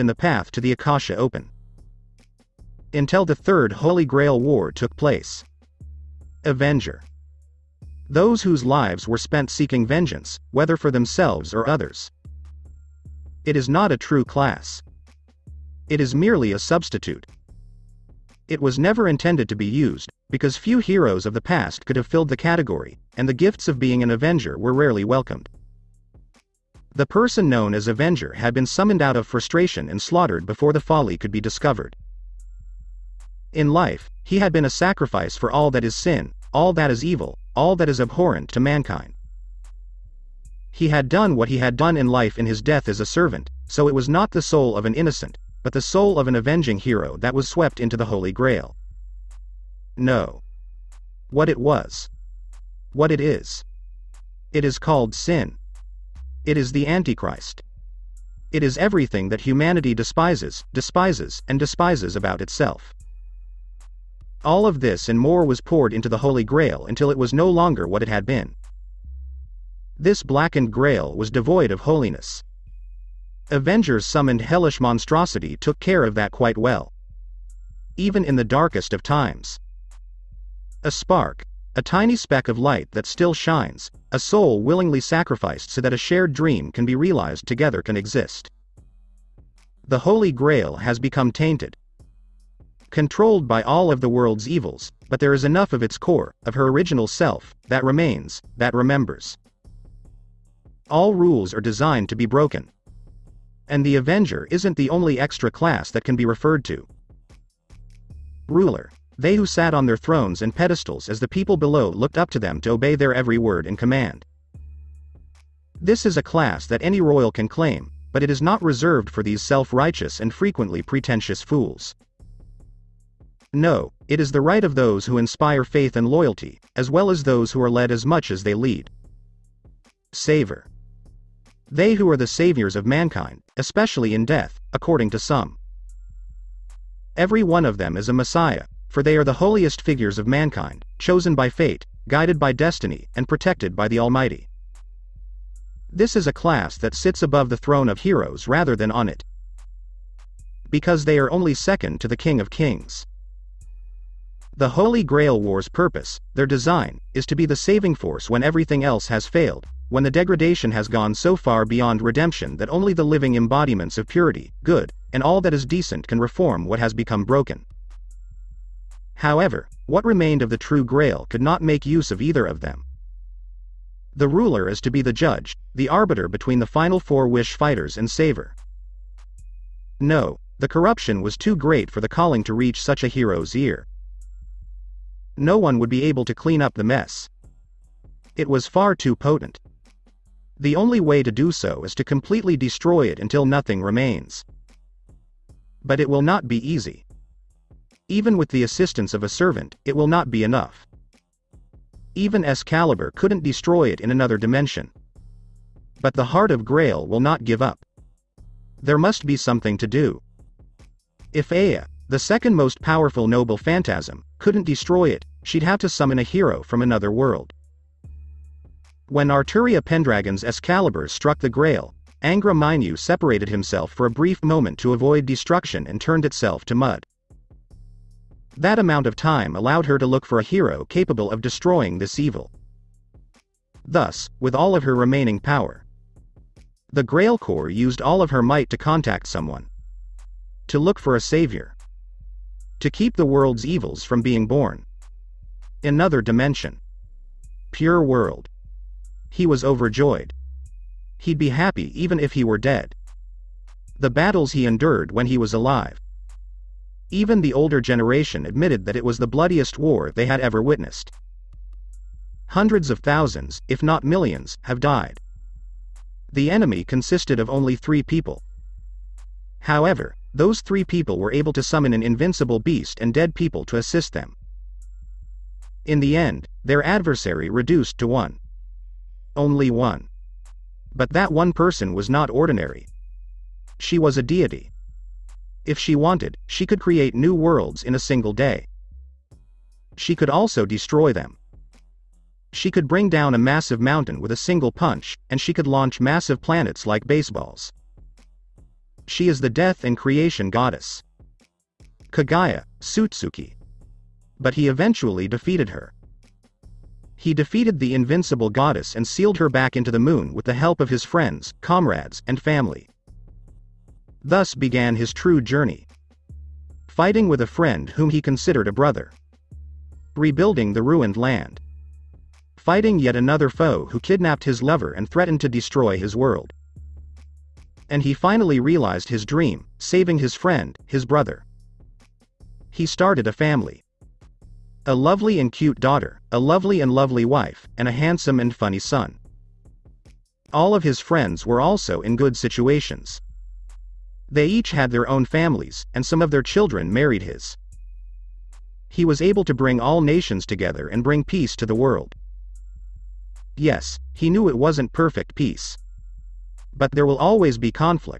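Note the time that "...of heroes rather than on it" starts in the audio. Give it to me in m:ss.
2:27.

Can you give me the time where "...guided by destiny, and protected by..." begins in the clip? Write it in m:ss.
2:22.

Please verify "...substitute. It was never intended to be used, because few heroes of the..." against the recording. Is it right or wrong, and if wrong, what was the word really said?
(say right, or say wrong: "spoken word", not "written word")
right.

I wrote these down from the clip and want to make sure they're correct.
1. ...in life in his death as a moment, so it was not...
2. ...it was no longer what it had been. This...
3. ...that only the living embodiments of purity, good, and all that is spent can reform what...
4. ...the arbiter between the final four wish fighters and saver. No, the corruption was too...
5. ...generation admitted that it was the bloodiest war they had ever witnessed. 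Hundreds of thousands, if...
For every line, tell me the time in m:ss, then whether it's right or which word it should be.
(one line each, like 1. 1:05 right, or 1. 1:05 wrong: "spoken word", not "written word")
1. 0:41 wrong: "servant", not "moment"
2. 1:07 right
3. 2:42 wrong: "decent", not "spent"
4. 2:55 right
5. 4:17 right.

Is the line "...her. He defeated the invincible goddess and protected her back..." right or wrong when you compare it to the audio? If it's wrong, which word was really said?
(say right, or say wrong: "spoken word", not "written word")
wrong: "sealed", not "protected".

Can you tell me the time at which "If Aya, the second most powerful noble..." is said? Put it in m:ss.
3:31.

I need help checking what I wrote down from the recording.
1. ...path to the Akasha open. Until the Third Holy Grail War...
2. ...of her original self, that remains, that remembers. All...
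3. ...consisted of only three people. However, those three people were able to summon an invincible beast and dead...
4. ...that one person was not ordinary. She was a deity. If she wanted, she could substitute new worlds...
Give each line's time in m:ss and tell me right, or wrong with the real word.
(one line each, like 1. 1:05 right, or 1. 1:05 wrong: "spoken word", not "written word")
1. 0:00 right
2. 1:36 right
3. 4:26 right
4. 4:41 wrong: "create", not "substitute".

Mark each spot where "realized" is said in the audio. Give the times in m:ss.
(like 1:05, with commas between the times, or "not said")
1:26, 5:28.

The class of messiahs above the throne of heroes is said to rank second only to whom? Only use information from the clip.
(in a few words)
King of Kings.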